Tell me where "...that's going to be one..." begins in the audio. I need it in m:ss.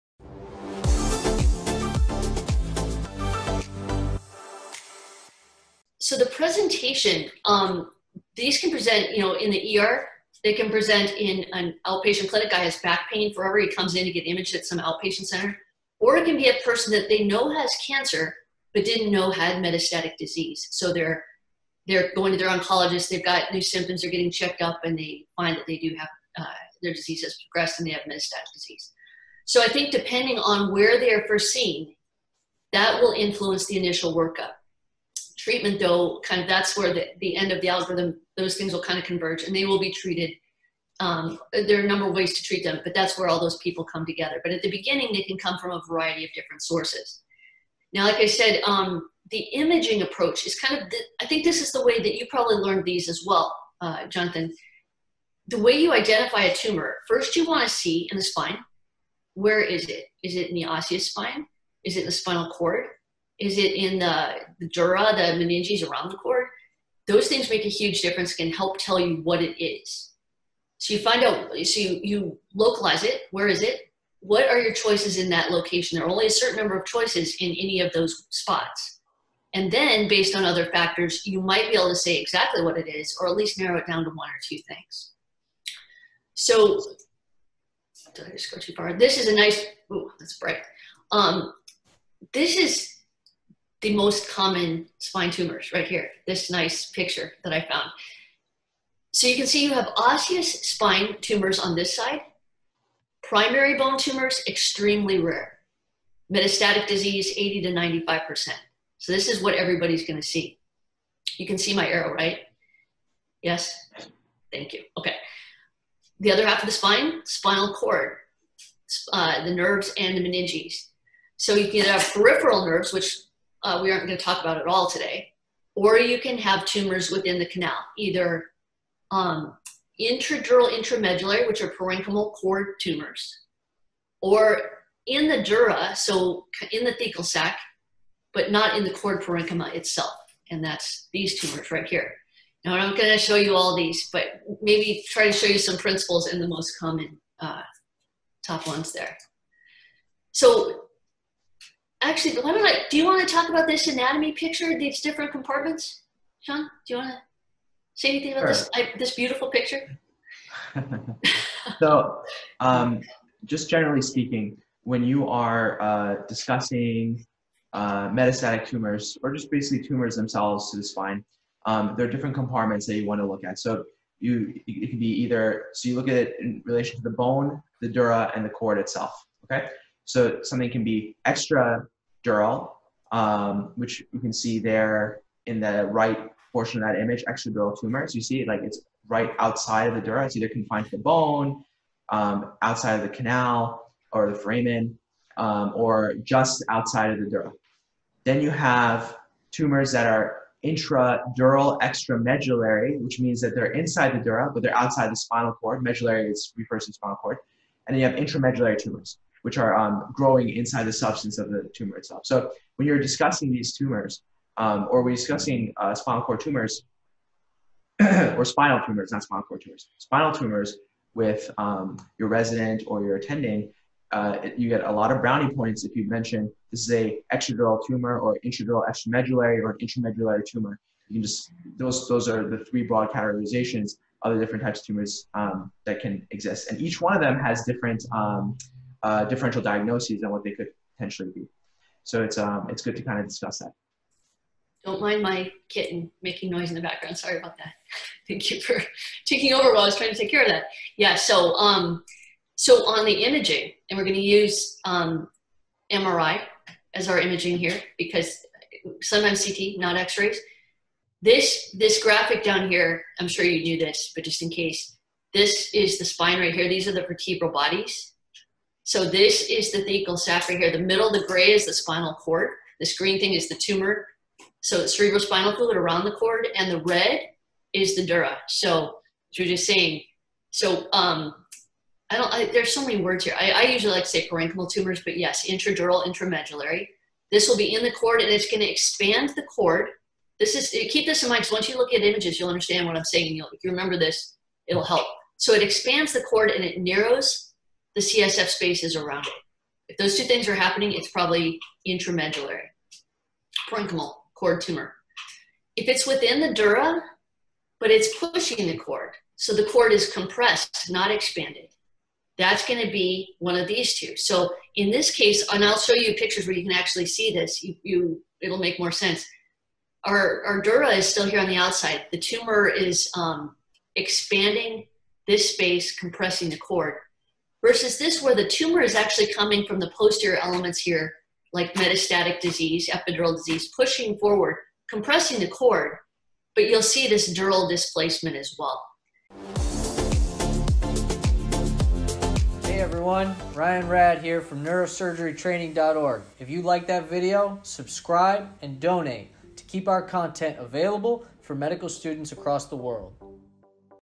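5:12.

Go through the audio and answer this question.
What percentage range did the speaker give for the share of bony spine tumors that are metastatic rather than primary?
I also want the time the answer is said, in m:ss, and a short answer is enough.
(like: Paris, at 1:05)
80 to 95%, at 1:47.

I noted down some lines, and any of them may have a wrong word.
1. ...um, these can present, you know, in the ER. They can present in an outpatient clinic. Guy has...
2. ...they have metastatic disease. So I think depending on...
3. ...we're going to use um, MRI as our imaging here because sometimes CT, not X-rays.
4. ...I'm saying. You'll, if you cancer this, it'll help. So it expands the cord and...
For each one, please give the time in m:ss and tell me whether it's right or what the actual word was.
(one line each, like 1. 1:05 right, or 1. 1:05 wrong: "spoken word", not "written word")
1. 0:07 right
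2. 0:27 right
3. 4:13 right
4. 4:52 wrong: "remember", not "cancer".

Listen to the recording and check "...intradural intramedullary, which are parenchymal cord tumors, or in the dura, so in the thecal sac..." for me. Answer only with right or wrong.
right.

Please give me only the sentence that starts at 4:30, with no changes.
The middle, the gray is the spinal cord.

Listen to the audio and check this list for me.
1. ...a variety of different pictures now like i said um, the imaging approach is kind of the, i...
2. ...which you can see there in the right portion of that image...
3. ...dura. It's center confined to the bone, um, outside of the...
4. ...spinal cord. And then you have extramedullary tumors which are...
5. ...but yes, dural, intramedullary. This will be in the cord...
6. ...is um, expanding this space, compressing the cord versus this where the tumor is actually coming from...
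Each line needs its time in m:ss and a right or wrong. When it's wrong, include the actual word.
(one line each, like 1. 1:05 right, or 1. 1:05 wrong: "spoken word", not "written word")
1. 0:45 wrong: "sources", not "pictures"
2. 3:03 right
3. 3:10 wrong: "either", not "center"
4. 3:26 wrong: "intramedullary", not "extramedullary"
5. 4:45 wrong: "intradural", not "dural"
6. 5:22 right.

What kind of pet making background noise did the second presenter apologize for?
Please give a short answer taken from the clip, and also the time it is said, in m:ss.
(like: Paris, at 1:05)
Kitten, at 4:05.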